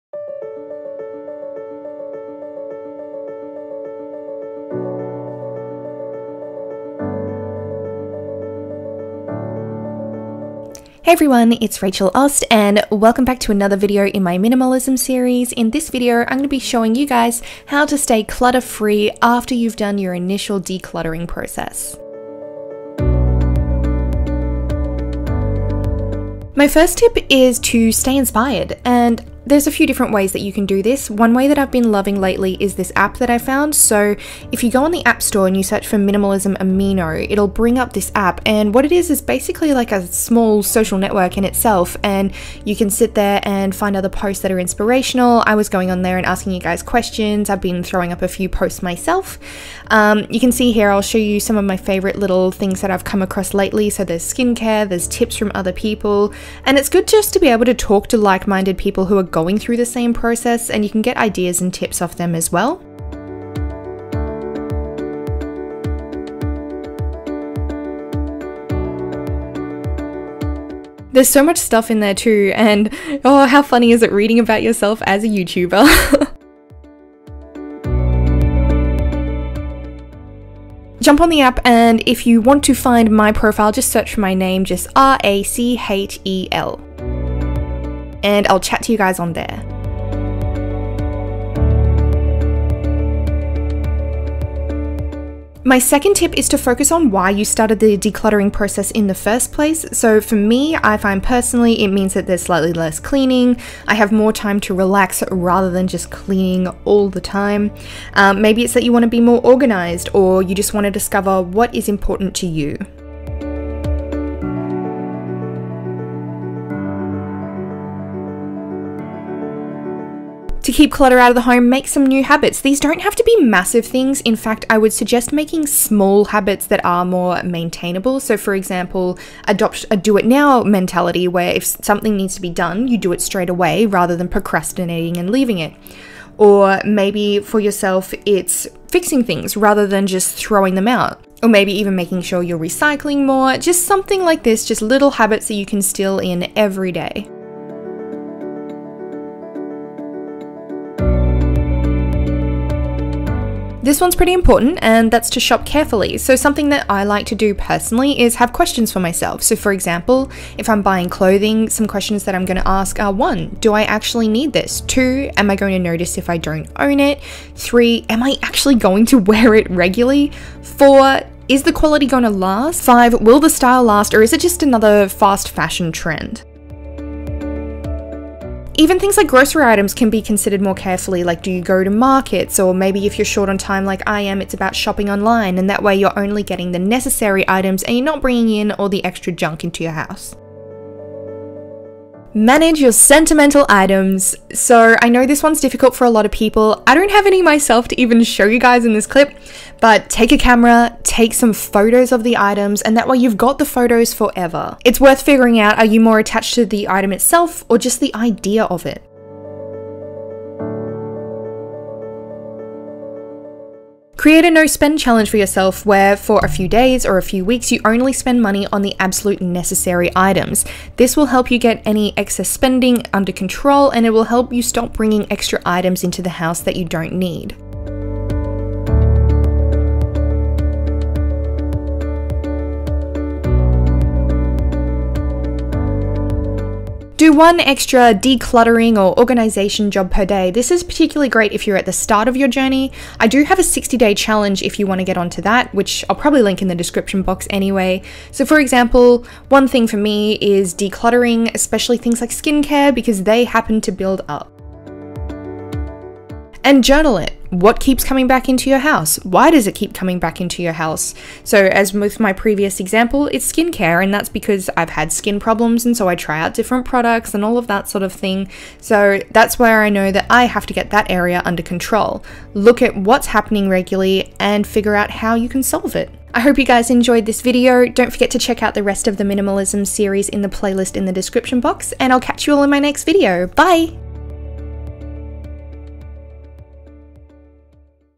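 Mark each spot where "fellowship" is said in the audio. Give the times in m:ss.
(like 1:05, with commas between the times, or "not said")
not said.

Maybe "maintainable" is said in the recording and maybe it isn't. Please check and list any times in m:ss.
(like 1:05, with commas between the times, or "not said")
2:07.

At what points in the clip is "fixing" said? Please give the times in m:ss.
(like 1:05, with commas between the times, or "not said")
2:18.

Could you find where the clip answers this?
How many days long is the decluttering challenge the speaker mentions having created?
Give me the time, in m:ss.
4:03.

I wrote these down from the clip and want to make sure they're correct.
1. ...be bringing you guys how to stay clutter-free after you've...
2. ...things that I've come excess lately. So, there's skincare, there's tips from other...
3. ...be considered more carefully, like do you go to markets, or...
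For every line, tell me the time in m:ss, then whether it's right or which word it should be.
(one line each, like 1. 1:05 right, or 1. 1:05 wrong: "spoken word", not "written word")
1. 0:16 wrong: "showing", not "bringing"
2. 0:52 wrong: "across", not "excess"
3. 3:00 right.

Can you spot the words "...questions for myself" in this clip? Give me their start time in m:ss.
2:38.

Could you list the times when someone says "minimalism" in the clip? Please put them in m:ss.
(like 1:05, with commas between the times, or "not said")
0:14, 0:35, 4:39.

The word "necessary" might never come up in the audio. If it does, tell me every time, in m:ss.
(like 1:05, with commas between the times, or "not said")
3:06, 3:39.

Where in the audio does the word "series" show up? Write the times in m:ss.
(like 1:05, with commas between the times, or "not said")
0:14, 4:39.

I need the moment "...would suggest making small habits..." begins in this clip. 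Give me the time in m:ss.
2:04.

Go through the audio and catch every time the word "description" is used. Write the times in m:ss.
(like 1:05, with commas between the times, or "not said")
4:06, 4:41.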